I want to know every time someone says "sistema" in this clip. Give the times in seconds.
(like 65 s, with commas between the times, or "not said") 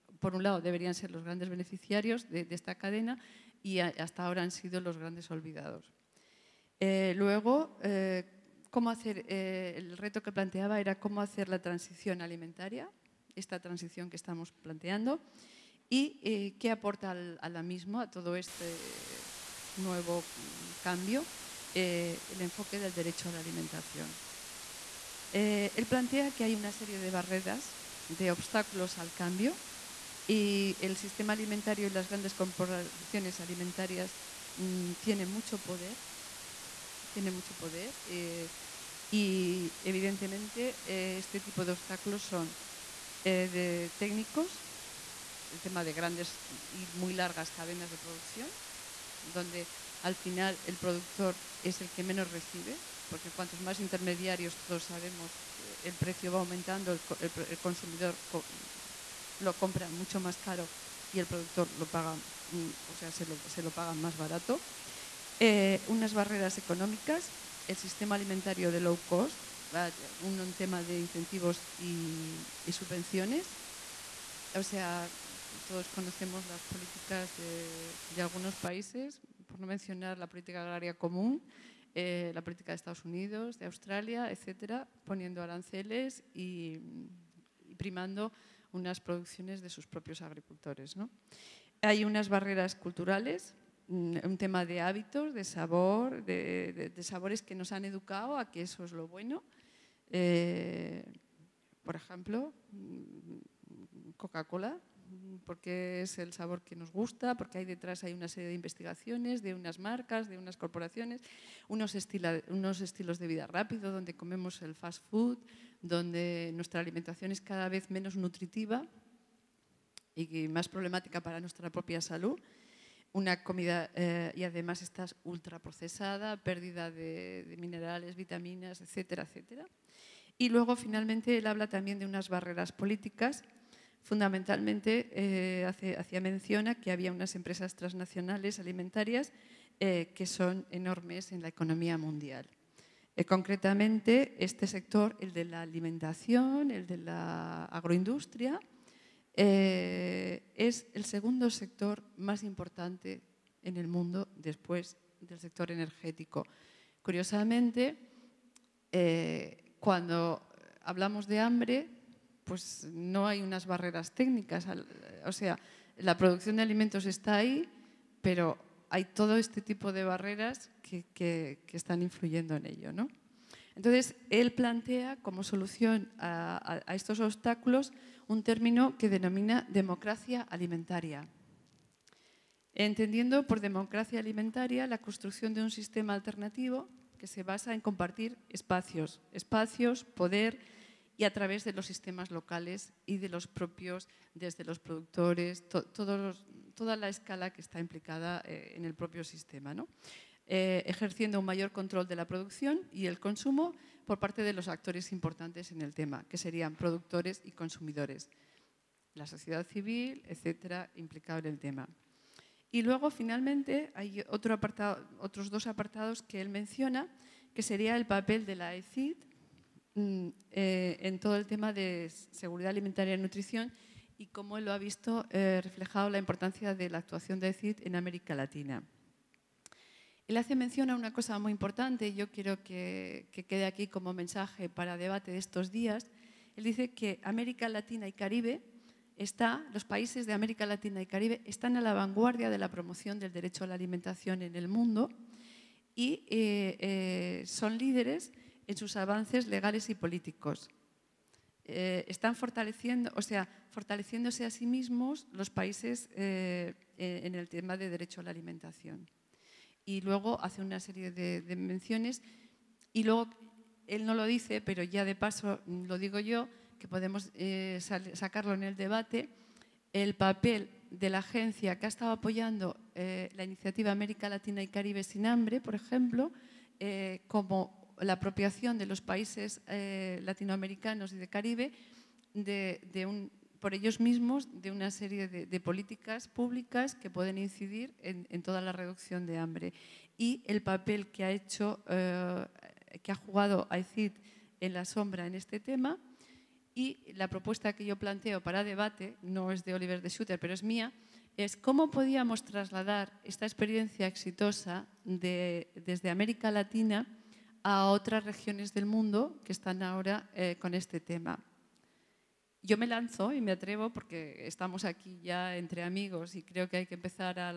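30 s, 67 s, 185 s, 191 s, 199 s.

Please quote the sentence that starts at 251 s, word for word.
Eh, están fortaleciendo, o sea, fortaleciéndose a sí mismos los países eh, en el tema de derecho a la alimentación.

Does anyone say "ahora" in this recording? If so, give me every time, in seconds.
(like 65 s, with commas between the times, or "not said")
4 s, 309 s.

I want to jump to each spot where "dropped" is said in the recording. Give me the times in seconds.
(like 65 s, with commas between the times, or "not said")
not said.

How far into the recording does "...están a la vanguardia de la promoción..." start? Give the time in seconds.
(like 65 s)
241 s.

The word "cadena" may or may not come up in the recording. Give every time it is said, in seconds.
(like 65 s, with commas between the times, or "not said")
2 s, 47 s.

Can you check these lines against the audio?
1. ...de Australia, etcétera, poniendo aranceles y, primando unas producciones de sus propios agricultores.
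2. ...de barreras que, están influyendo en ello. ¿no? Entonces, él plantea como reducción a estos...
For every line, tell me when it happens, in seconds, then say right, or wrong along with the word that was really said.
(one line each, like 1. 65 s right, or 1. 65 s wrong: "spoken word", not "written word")
1. 83 s right
2. 169 s wrong: "solución", not "reducción".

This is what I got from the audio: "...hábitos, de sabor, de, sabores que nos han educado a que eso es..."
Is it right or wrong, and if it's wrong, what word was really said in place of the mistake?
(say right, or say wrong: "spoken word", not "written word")
right.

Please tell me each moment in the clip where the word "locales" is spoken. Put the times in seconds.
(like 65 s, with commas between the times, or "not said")
192 s.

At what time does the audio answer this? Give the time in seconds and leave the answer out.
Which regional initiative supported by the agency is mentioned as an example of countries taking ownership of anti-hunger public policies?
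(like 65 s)
273 s.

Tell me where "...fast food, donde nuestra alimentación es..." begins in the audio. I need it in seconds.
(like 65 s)
114 s.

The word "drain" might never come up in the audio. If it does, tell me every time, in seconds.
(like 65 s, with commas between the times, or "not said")
not said.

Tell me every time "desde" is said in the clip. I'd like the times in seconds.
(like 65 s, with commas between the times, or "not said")
194 s, 305 s.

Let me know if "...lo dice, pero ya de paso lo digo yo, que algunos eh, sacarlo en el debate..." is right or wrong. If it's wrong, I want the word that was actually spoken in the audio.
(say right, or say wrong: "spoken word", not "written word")
wrong: "podemos", not "algunos".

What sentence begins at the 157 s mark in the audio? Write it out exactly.
Curiosamente, cuando hablamos de hambre, pues no hay unas barreras técnicas.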